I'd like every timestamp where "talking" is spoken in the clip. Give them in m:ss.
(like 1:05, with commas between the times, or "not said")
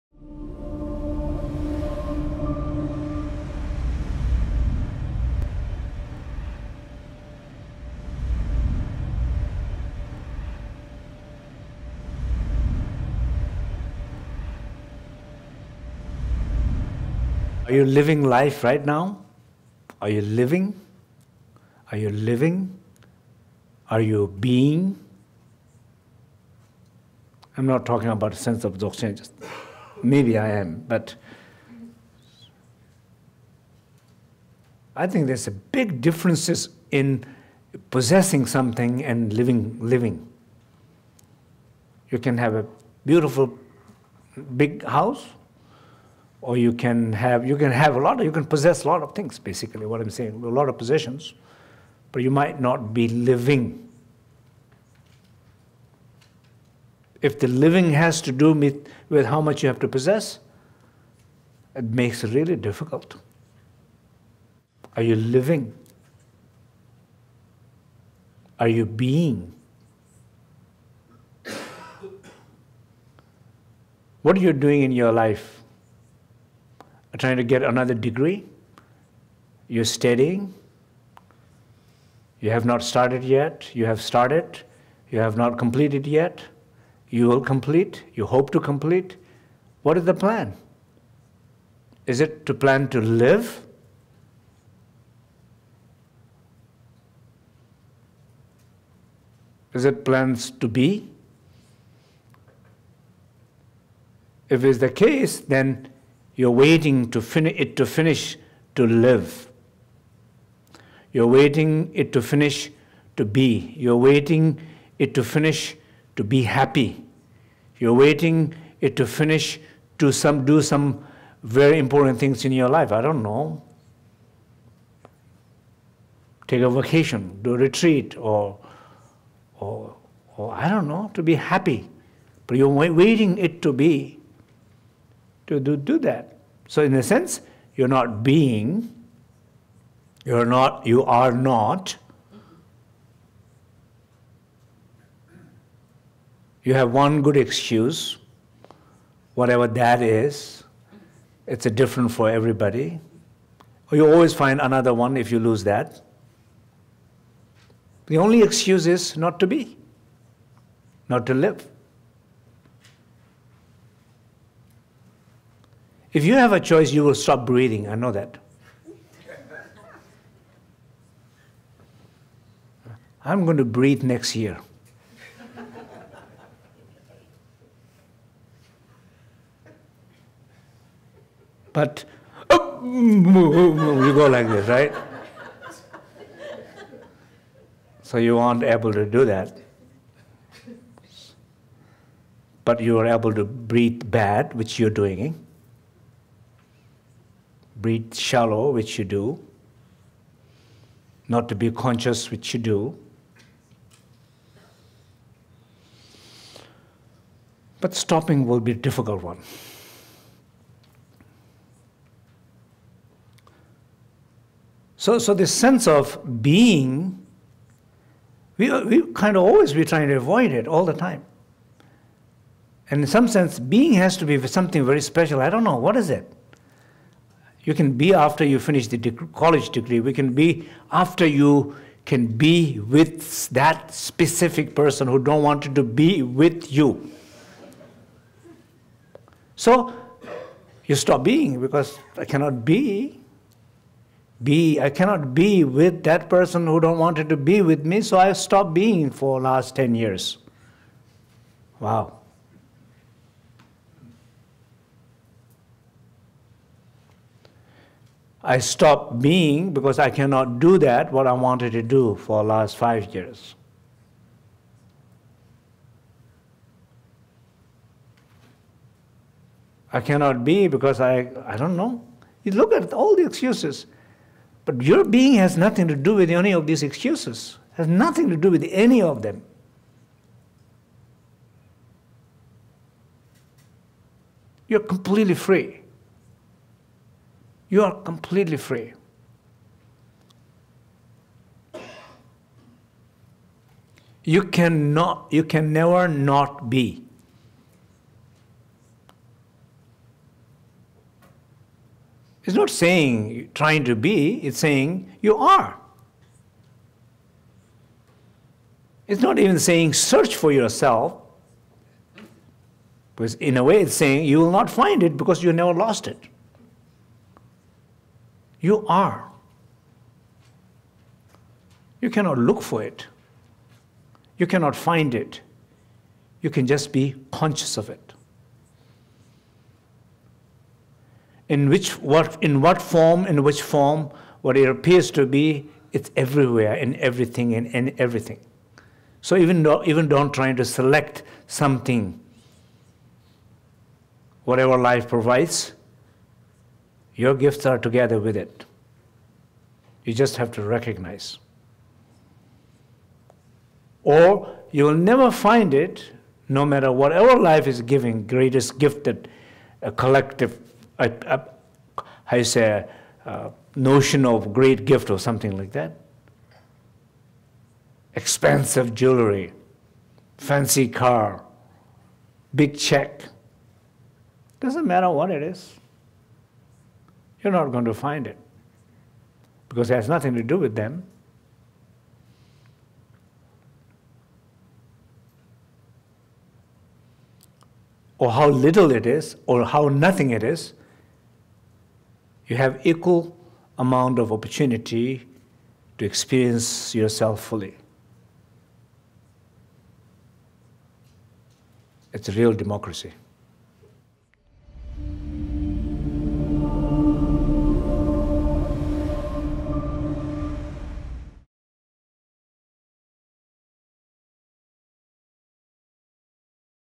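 0:27.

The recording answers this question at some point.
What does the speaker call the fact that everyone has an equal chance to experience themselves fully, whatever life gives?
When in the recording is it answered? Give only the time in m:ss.
6:42.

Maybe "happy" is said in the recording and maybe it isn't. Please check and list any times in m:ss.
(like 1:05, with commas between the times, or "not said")
1:56, 2:11.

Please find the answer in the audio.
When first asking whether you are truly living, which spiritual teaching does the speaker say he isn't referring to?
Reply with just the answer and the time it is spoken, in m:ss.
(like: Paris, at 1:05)
Dzogchen, at 0:28.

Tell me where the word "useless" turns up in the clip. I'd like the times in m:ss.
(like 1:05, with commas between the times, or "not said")
not said.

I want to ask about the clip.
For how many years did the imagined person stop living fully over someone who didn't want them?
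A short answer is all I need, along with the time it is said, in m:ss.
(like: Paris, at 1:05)
10 years, at 4:09.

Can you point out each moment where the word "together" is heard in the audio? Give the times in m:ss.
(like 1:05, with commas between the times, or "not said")
5:47.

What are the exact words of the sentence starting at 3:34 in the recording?
So, so this sense of being, we, we kind of always be trying to avoid it all the time.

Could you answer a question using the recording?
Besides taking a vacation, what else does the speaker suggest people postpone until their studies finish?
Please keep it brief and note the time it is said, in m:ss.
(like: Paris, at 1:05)
A retreat, at 2:07.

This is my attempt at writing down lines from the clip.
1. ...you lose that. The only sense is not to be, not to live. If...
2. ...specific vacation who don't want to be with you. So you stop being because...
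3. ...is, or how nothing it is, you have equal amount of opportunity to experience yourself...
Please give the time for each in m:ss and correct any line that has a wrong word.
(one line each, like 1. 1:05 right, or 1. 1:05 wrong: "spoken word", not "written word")
1. 2:35 wrong: "excuse", not "sense"
2. 3:53 wrong: "person", not "vacation"
3. 6:29 right.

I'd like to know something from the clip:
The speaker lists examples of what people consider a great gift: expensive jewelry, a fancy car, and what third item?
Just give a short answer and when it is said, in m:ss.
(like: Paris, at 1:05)
Big check, at 6:12.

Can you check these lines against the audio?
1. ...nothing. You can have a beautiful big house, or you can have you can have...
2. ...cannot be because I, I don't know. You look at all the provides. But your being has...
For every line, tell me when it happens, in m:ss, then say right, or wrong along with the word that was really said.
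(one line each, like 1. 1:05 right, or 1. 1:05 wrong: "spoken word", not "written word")
1. 0:39 wrong: "living", not "nothing"
2. 4:29 wrong: "excuses", not "provides".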